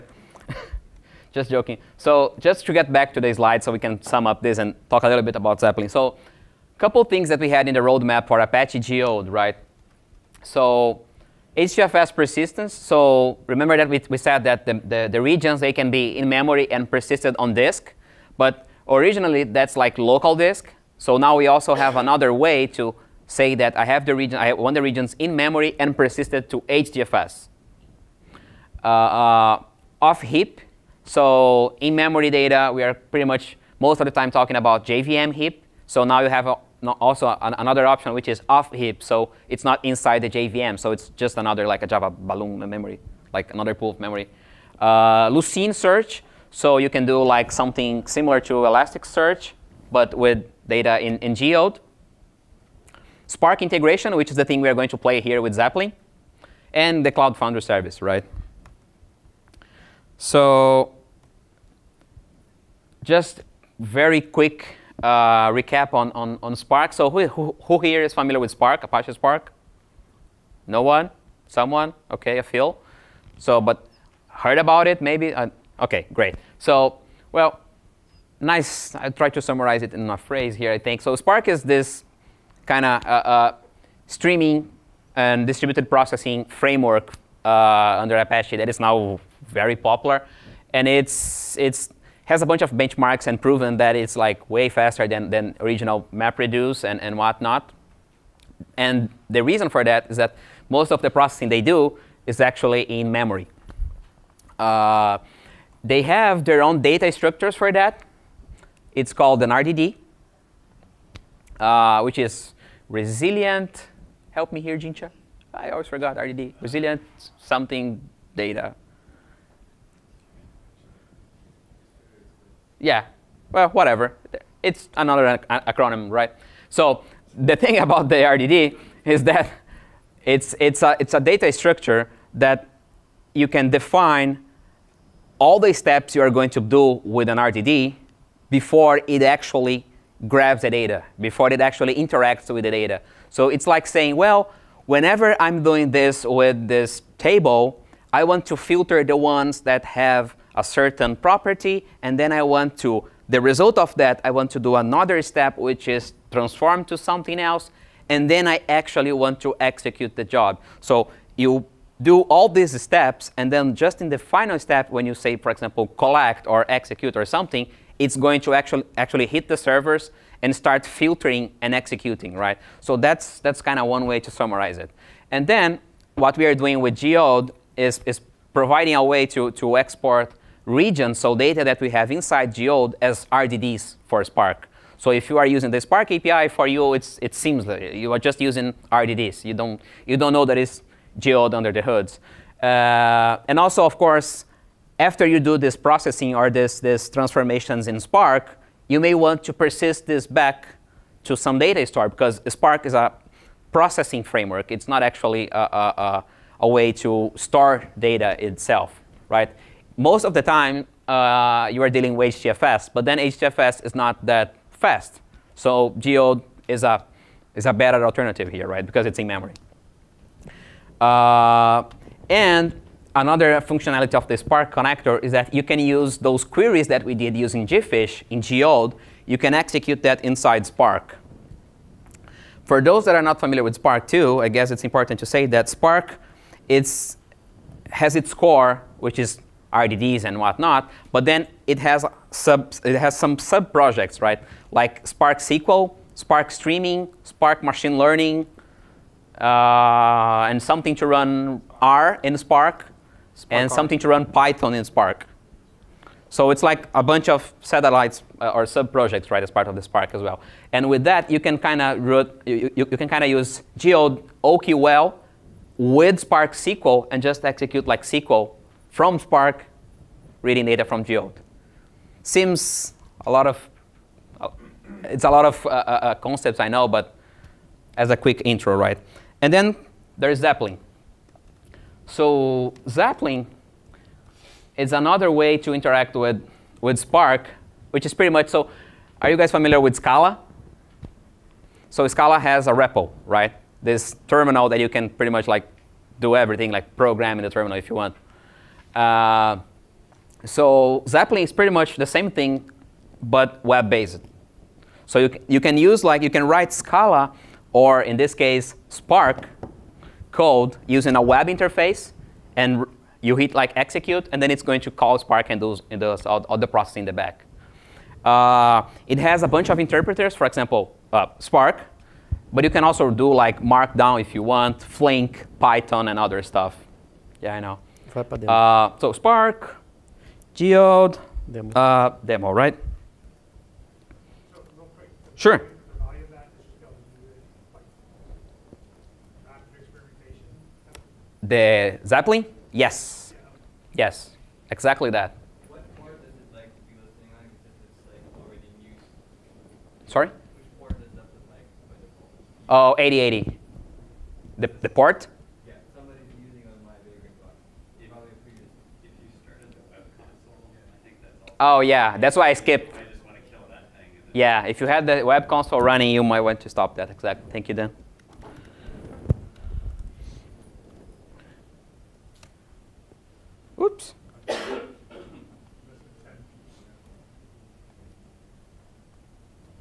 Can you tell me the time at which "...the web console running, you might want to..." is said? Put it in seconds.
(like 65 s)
365 s.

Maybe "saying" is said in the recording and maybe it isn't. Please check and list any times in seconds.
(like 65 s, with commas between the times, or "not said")
143 s.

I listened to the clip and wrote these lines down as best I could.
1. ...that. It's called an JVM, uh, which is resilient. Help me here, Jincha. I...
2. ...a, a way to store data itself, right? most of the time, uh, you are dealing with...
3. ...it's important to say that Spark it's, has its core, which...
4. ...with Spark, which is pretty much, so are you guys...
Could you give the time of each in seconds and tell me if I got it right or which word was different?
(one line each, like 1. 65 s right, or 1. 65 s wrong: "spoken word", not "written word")
1. 107 s wrong: "RDD", not "JVM"
2. 205 s right
3. 234 s right
4. 286 s right.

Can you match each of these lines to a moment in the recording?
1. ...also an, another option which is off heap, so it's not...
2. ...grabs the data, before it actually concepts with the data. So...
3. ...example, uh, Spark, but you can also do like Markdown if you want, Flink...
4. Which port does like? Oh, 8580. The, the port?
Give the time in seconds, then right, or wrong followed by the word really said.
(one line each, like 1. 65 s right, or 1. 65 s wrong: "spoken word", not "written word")
1. 36 s right
2. 140 s wrong: "interacts", not "concepts"
3. 320 s right
4. 350 s wrong: "8080", not "8580".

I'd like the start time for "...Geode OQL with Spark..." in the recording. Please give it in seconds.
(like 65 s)
263 s.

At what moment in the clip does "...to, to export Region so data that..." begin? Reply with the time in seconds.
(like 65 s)
179 s.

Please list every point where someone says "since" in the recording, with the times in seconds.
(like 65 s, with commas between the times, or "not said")
not said.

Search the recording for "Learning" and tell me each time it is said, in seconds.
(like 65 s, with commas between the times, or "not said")
247 s.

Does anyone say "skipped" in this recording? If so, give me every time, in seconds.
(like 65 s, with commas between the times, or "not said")
362 s.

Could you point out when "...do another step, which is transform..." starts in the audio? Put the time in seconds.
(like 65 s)
154 s.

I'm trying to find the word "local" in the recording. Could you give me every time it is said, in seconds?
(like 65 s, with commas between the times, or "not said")
19 s.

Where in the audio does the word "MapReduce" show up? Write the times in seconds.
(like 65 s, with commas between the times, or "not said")
96 s.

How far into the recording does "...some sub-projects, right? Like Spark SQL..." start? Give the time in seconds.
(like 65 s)
243 s.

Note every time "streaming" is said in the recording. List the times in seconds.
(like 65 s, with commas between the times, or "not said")
84 s, 246 s.